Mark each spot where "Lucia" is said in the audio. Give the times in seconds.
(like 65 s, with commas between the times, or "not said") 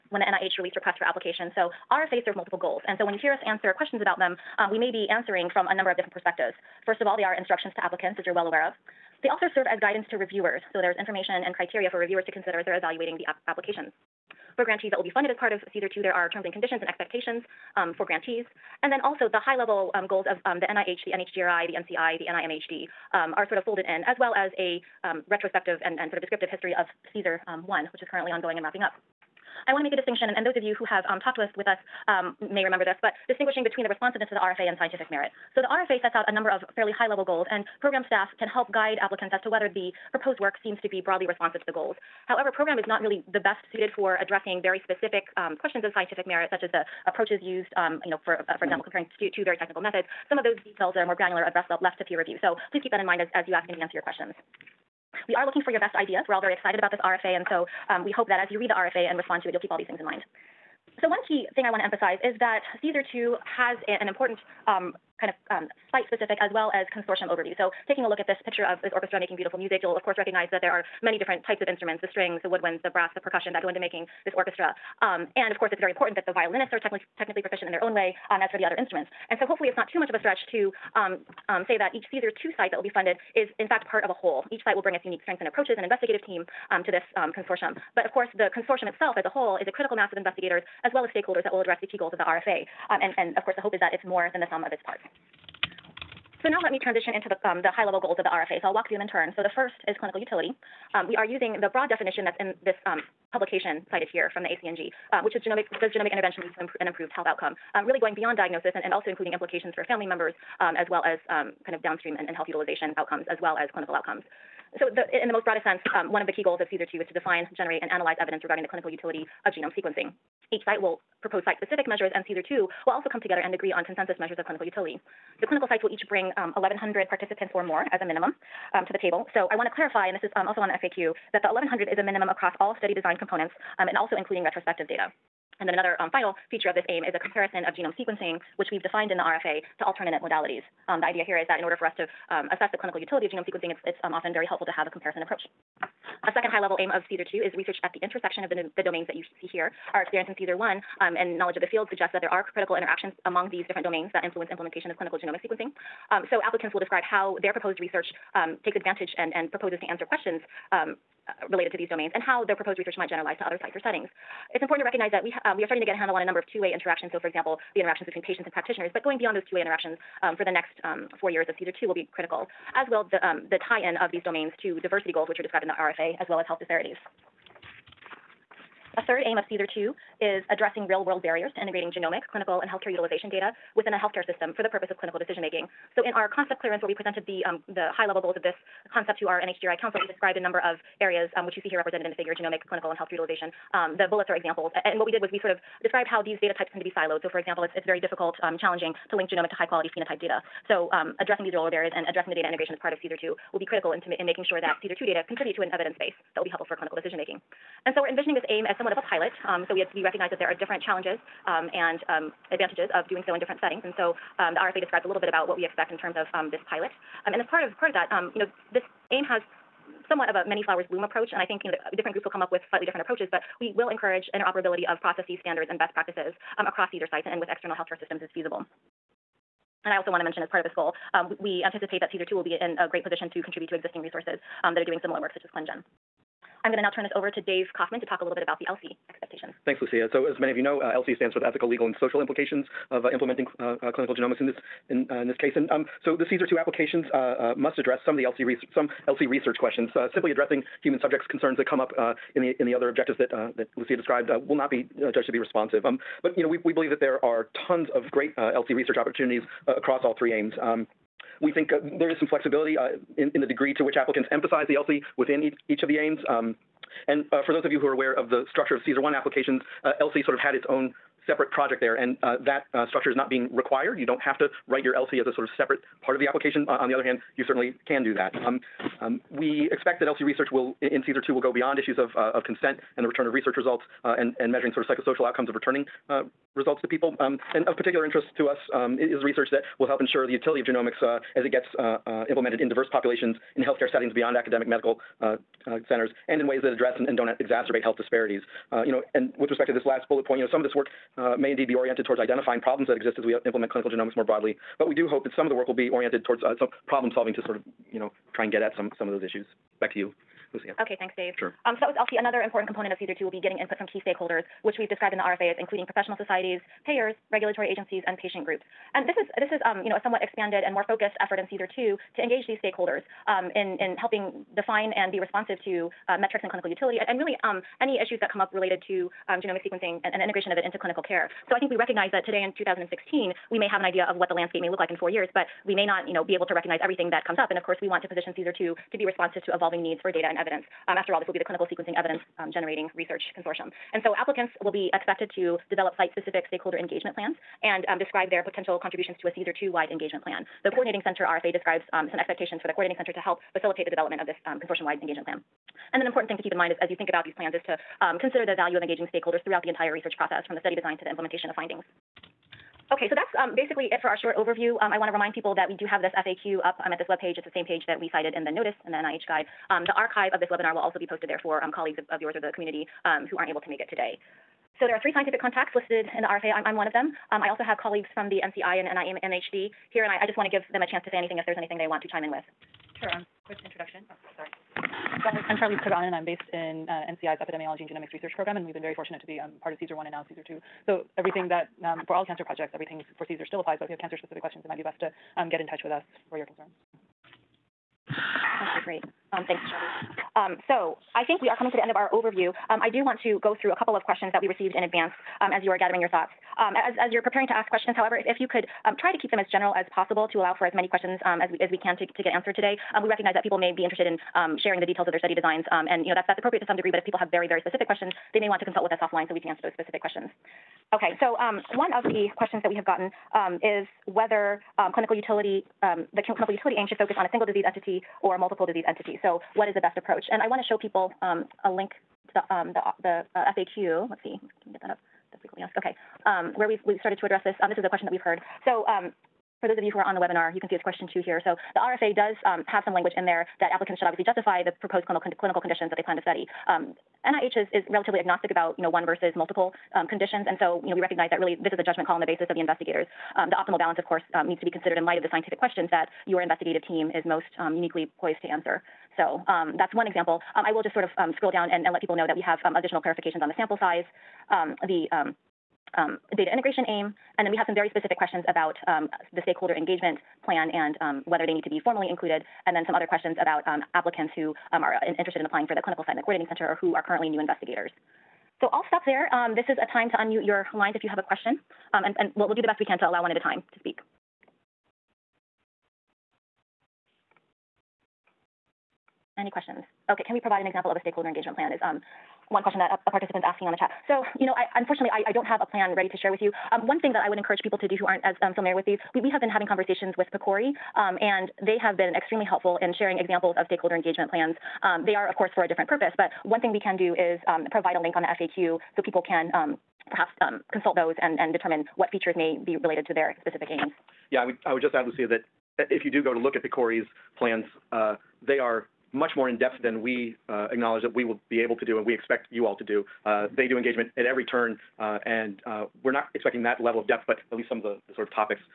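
239 s, 253 s, 310 s, 515 s.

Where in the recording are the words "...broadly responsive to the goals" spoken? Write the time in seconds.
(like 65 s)
41 s.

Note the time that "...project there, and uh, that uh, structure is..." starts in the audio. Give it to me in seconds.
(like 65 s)
271 s.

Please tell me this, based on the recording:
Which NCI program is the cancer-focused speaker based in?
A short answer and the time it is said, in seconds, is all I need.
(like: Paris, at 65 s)
Epidemiology and Genomics Research Program, at 387 s.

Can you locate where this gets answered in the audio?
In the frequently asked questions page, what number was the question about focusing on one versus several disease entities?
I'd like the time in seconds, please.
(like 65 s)
440 s.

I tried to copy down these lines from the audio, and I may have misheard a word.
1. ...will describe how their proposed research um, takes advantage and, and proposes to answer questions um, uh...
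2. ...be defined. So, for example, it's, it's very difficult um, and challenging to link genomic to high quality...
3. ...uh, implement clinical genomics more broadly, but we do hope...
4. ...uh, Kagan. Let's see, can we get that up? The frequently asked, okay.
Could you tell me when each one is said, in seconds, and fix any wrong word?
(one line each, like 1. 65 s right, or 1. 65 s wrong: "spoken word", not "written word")
1. 156 s right
2. 196 s wrong: "siloed", not "defined"
3. 303 s right
4. 433 s wrong: "FAQ", not "Kagan".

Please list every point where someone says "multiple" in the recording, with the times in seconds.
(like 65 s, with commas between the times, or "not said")
2 s, 428 s, 449 s.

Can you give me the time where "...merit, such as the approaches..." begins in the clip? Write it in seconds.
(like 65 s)
46 s.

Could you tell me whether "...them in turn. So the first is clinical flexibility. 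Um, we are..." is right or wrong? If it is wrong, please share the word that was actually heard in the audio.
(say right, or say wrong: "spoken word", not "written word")
wrong: "utility", not "flexibility".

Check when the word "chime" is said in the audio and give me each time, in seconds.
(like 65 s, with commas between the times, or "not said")
382 s.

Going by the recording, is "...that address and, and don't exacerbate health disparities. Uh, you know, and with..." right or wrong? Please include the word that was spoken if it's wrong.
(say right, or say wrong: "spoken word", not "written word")
right.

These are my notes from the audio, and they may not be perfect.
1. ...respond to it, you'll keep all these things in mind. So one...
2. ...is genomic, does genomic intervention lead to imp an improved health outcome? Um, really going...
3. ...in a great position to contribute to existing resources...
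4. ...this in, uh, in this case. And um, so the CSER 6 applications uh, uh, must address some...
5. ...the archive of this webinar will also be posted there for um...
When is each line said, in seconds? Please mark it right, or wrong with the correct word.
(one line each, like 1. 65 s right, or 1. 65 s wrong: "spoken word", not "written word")
1. 59 s right
2. 105 s right
3. 232 s right
4. 244 s wrong: "2", not "6"
5. 369 s right.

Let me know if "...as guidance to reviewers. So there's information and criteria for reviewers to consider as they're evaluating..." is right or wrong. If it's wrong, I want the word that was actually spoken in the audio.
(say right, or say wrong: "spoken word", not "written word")
right.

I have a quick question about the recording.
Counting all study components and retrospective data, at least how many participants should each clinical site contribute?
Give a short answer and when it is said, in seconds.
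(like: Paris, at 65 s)
1,100, at 126 s.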